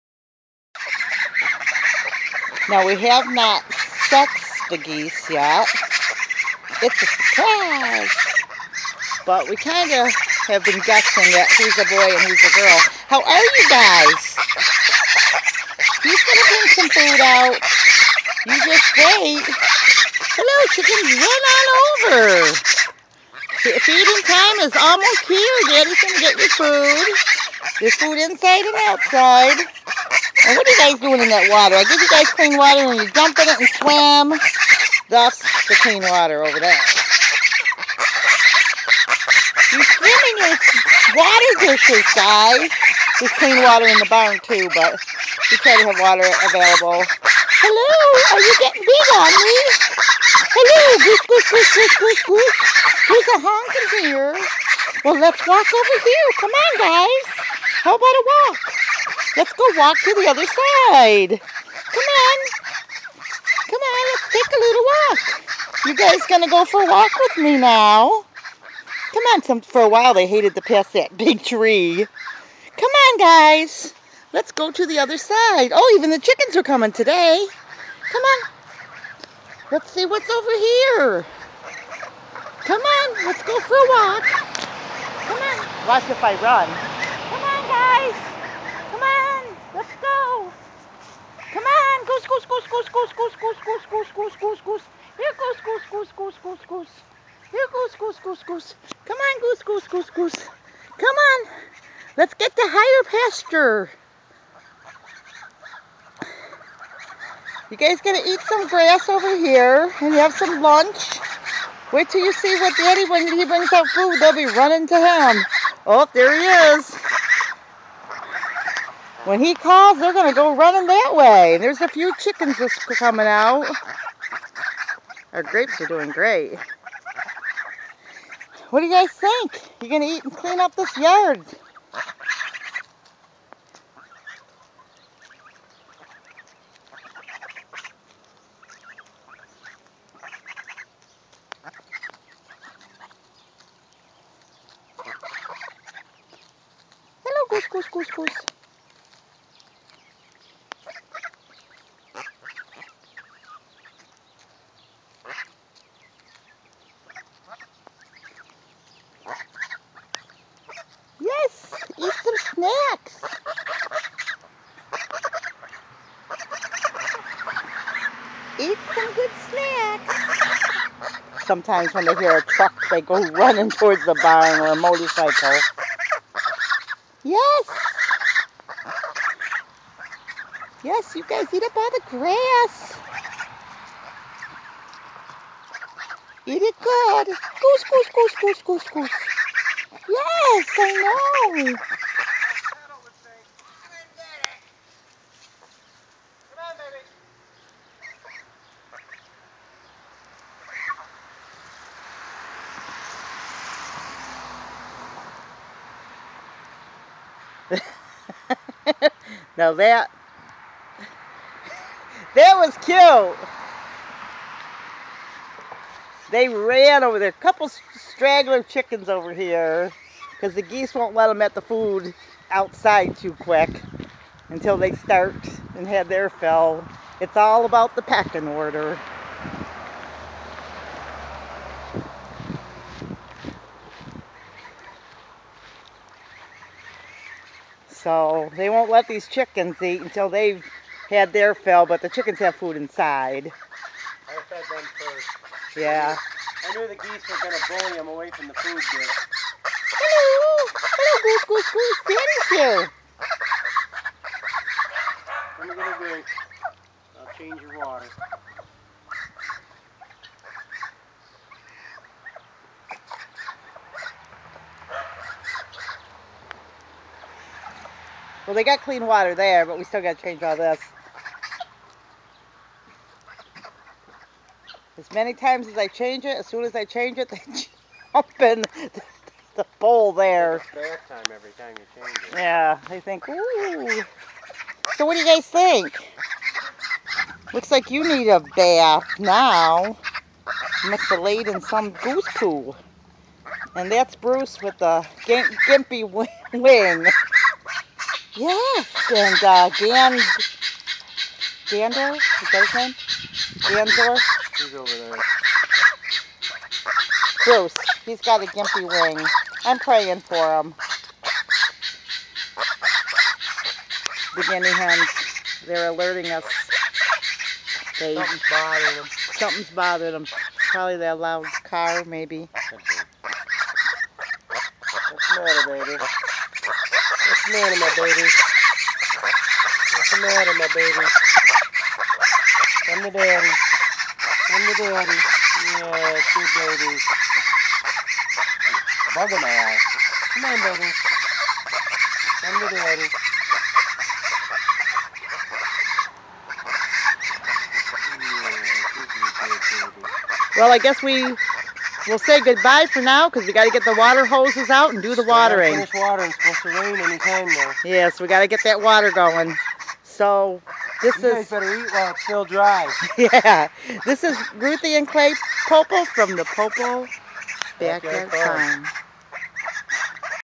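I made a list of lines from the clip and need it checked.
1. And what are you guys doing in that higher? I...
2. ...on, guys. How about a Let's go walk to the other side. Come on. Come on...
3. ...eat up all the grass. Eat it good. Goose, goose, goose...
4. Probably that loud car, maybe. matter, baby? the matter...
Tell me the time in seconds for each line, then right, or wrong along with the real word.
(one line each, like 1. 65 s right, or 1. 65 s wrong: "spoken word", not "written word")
1. 30 s wrong: "water", not "higher"
2. 56 s right
3. 181 s right
4. 320 s right.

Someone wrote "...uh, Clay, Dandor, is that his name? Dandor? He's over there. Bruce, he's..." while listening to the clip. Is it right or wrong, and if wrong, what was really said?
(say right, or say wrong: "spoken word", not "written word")
wrong: "Dan", not "Clay".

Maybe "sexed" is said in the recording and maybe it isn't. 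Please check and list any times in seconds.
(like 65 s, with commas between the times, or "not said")
4 s.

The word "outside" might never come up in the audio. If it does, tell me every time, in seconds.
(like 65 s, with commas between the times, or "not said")
28 s, 222 s.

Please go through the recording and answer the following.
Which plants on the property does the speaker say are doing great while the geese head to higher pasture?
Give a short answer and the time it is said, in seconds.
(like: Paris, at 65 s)
Grapes, at 125 s.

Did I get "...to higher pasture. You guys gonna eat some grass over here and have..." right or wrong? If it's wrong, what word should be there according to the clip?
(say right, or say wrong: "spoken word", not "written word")
right.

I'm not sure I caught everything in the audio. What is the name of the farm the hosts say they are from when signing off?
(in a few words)
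Pople Backyard Farm.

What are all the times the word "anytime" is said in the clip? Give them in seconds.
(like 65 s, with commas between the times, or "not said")
356 s.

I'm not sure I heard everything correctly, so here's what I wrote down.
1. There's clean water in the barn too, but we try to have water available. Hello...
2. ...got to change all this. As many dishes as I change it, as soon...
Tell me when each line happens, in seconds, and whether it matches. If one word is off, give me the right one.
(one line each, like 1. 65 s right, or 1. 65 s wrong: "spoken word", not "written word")
1. 43 s right
2. 270 s wrong: "times", not "dishes".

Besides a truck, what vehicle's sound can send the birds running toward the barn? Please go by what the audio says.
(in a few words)
Motorcycle.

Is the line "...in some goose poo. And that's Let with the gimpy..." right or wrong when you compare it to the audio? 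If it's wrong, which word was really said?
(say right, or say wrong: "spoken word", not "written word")
wrong: "Bruce", not "Let".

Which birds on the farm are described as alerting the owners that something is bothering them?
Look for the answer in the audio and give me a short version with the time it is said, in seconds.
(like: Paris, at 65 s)
Guinea hens, at 314 s.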